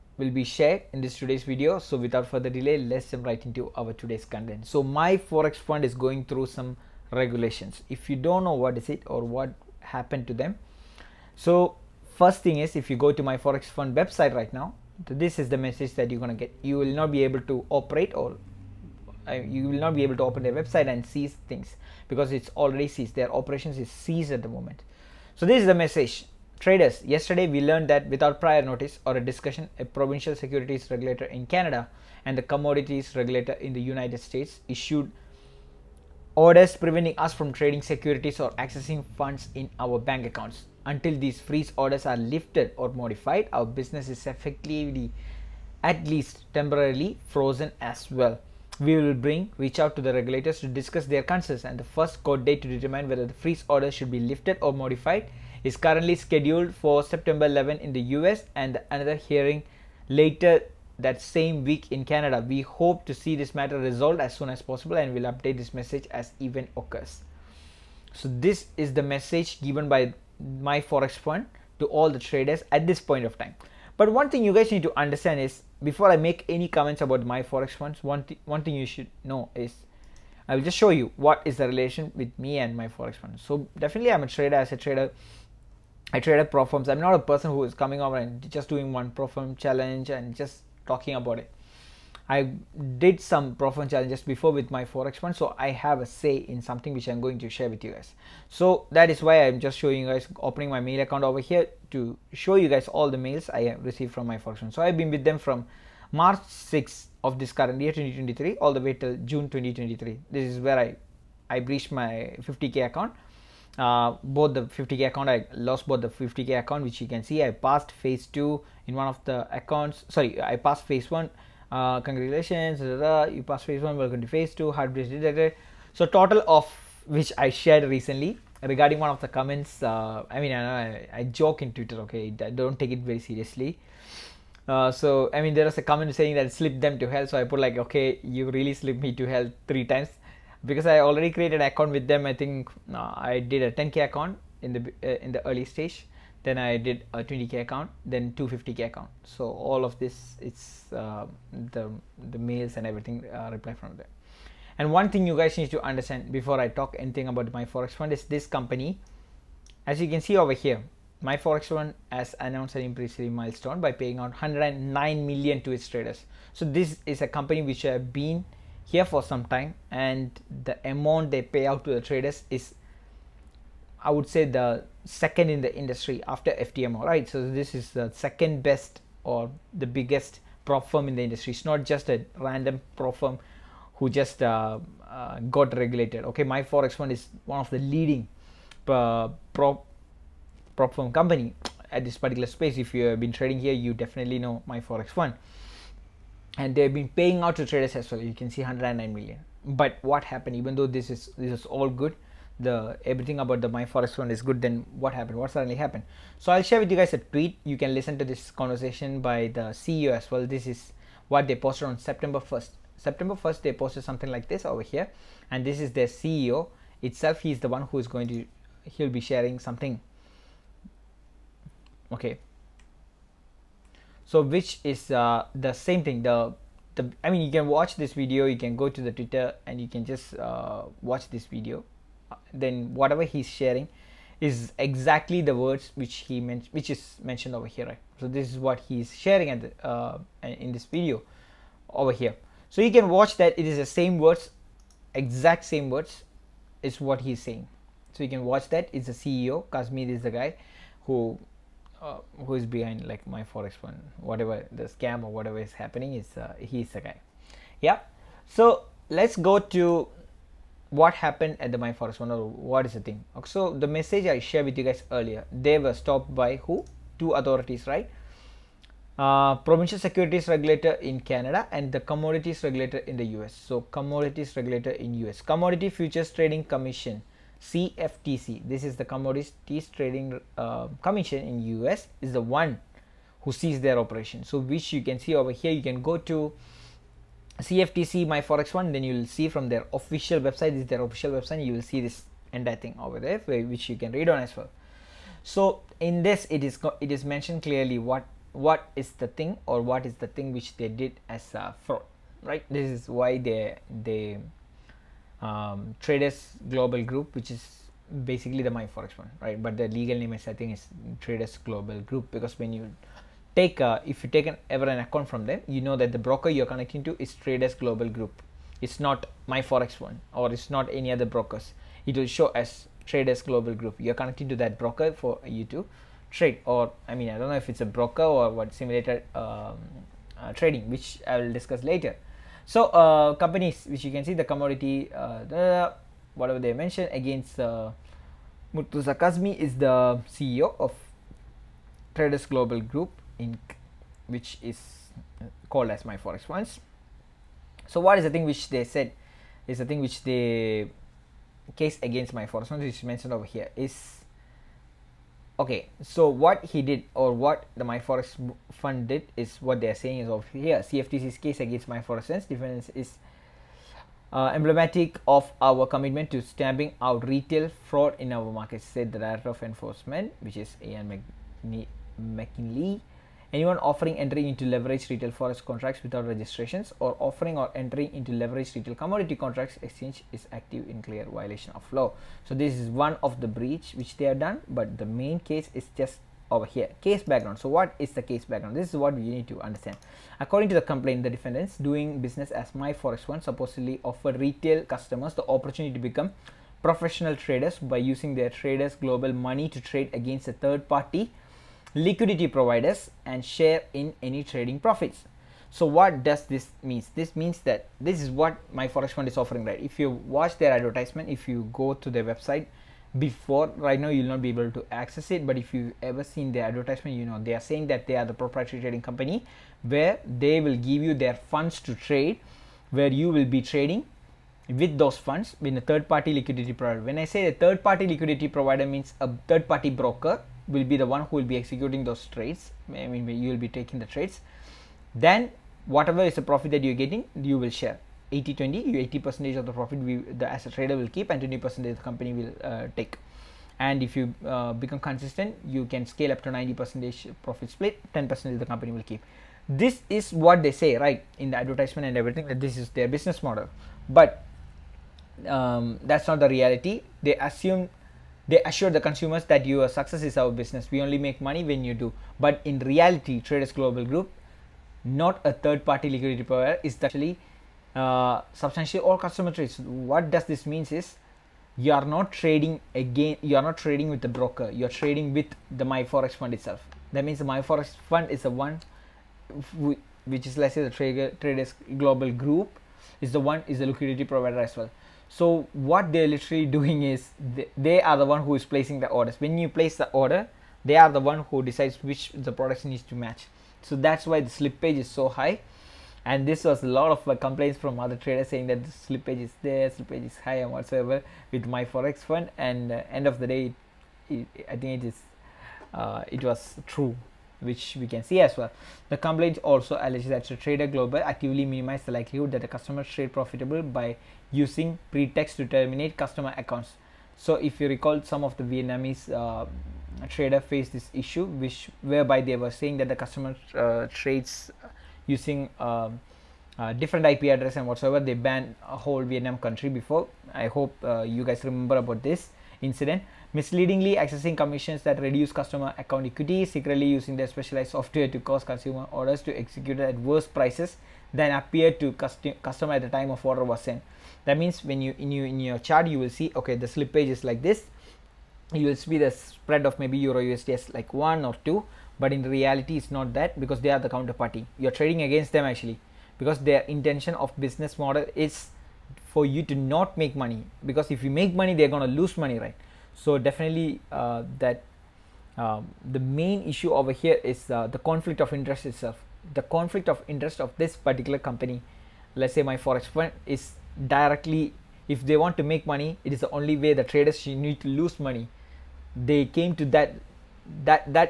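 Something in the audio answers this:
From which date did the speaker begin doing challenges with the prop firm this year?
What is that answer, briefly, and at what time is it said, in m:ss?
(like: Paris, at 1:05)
March 6th, at 1:46.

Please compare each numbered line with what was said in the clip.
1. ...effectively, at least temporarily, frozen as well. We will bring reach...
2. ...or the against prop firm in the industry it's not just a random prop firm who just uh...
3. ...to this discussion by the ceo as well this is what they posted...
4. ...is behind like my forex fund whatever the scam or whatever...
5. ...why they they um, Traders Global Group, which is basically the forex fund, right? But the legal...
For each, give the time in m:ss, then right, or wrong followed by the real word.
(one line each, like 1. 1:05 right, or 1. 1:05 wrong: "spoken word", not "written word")
1. 0:44 right
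2. 2:59 wrong: "biggest", not "against"
3. 3:28 wrong: "conversation", not "discussion"
4. 4:12 right
5. 5:03 right.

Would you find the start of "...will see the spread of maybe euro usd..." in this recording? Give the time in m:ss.
9:08.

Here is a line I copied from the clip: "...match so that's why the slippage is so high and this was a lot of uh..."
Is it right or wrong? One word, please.
right.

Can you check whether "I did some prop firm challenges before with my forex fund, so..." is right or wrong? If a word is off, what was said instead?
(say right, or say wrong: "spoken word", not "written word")
right.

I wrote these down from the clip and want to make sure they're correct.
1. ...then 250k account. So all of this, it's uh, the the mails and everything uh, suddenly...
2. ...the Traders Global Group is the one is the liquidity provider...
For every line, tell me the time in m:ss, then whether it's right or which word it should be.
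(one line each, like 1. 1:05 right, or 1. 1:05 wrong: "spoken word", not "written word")
1. 2:28 wrong: "reply", not "suddenly"
2. 8:00 right.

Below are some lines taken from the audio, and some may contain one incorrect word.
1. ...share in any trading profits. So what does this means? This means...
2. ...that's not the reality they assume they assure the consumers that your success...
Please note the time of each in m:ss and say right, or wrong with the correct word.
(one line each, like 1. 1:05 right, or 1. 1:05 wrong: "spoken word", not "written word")
1. 6:43 right
2. 7:36 right.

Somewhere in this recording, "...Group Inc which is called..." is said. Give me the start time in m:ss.
5:42.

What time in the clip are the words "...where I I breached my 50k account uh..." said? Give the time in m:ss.
1:50.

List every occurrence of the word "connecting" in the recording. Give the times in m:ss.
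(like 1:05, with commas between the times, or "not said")
5:16, 5:24.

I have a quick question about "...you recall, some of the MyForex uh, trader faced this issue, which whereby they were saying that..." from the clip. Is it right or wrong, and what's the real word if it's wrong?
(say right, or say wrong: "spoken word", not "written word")
wrong: "Vietnamese", not "MyForex".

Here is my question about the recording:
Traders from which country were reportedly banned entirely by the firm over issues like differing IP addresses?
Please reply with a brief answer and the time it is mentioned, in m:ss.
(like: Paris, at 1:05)
Vietnam, at 8:49.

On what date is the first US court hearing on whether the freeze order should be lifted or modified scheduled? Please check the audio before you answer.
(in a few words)
September 11.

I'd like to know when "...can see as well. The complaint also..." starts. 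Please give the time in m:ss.
8:28.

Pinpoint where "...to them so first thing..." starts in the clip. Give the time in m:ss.
0:10.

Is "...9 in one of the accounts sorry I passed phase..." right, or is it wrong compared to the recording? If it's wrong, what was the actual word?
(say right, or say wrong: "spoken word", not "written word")
wrong: "2", not "9".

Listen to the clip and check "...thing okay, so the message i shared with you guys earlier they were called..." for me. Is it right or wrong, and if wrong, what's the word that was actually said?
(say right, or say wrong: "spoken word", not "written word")
wrong: "stopped", not "called".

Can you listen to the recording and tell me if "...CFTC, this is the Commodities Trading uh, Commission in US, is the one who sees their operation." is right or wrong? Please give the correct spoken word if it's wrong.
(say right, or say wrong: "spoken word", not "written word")
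right.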